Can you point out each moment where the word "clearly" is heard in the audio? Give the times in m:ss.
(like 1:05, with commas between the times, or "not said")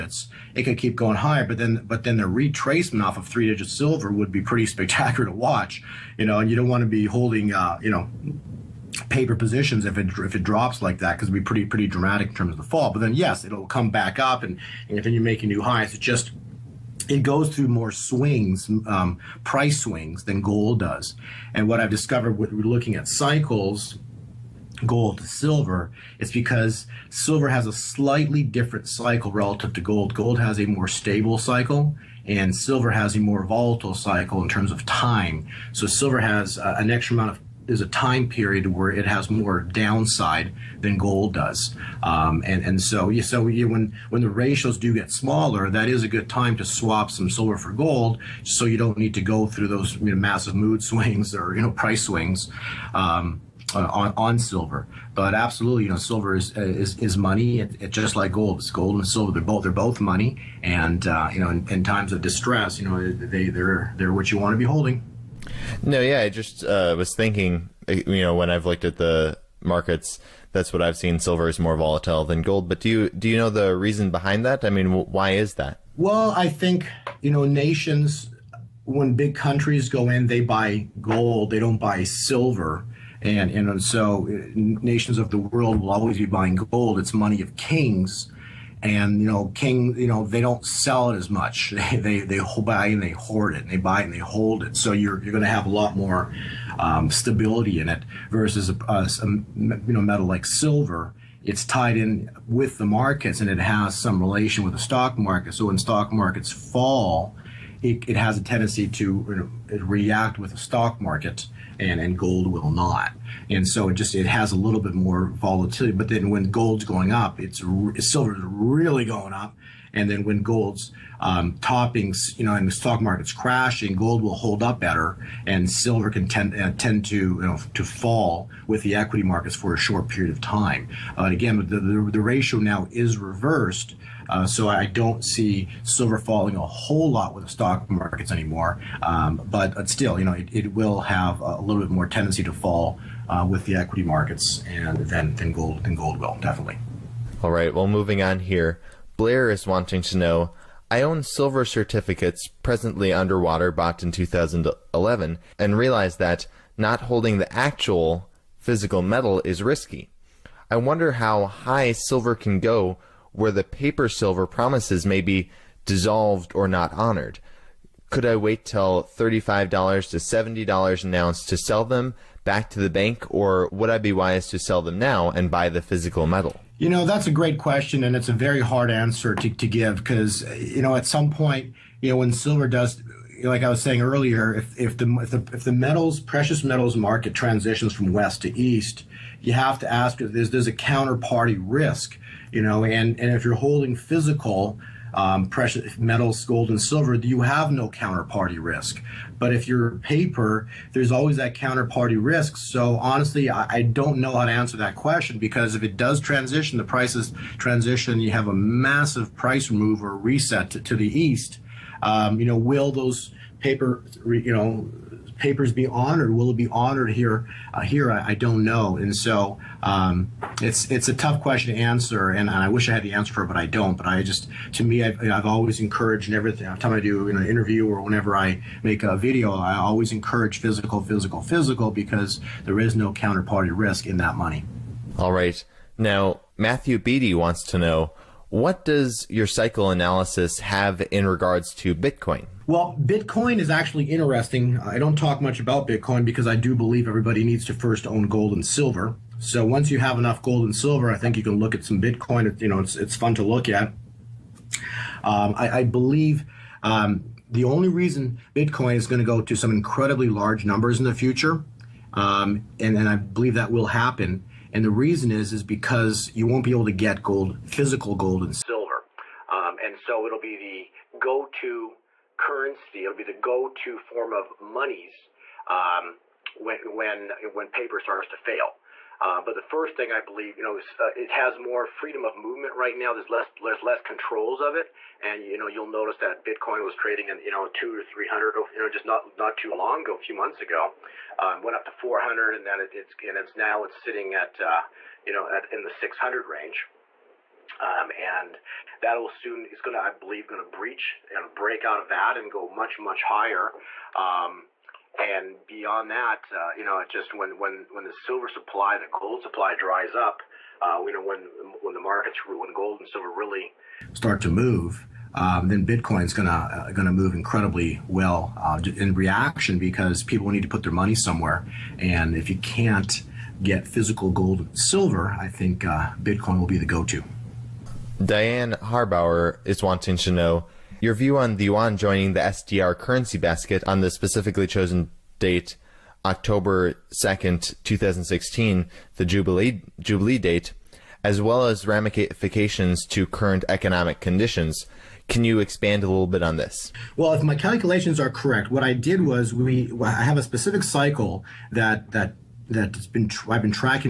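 not said.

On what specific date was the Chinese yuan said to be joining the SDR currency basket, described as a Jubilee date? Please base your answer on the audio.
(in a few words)
October 2nd, 2016.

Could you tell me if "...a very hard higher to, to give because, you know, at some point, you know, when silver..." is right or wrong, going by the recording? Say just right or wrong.
wrong.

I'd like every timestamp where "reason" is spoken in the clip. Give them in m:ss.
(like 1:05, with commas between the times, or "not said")
1:13, 4:17, 4:24.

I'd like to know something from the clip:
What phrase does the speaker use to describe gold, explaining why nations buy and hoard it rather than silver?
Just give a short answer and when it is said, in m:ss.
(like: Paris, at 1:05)
Money of kings, at 1:27.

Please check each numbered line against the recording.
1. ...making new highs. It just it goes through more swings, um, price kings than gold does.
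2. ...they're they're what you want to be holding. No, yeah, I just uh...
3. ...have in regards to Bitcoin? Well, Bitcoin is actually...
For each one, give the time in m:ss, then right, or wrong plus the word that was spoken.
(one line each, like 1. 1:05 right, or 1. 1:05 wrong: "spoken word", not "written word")
1. 0:15 wrong: "swings", not "kings"
2. 1:03 right
3. 4:00 right.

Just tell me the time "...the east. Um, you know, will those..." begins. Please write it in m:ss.
3:30.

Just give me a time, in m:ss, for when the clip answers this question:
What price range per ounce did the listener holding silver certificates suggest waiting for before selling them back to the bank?
2:49.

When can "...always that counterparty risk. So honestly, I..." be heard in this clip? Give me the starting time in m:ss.
3:21.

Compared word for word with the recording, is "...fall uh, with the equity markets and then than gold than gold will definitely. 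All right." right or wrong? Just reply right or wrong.
right.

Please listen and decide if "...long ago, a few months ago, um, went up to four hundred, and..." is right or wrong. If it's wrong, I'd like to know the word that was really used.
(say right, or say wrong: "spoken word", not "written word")
right.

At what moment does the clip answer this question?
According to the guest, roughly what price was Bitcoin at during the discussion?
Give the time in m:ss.
4:55.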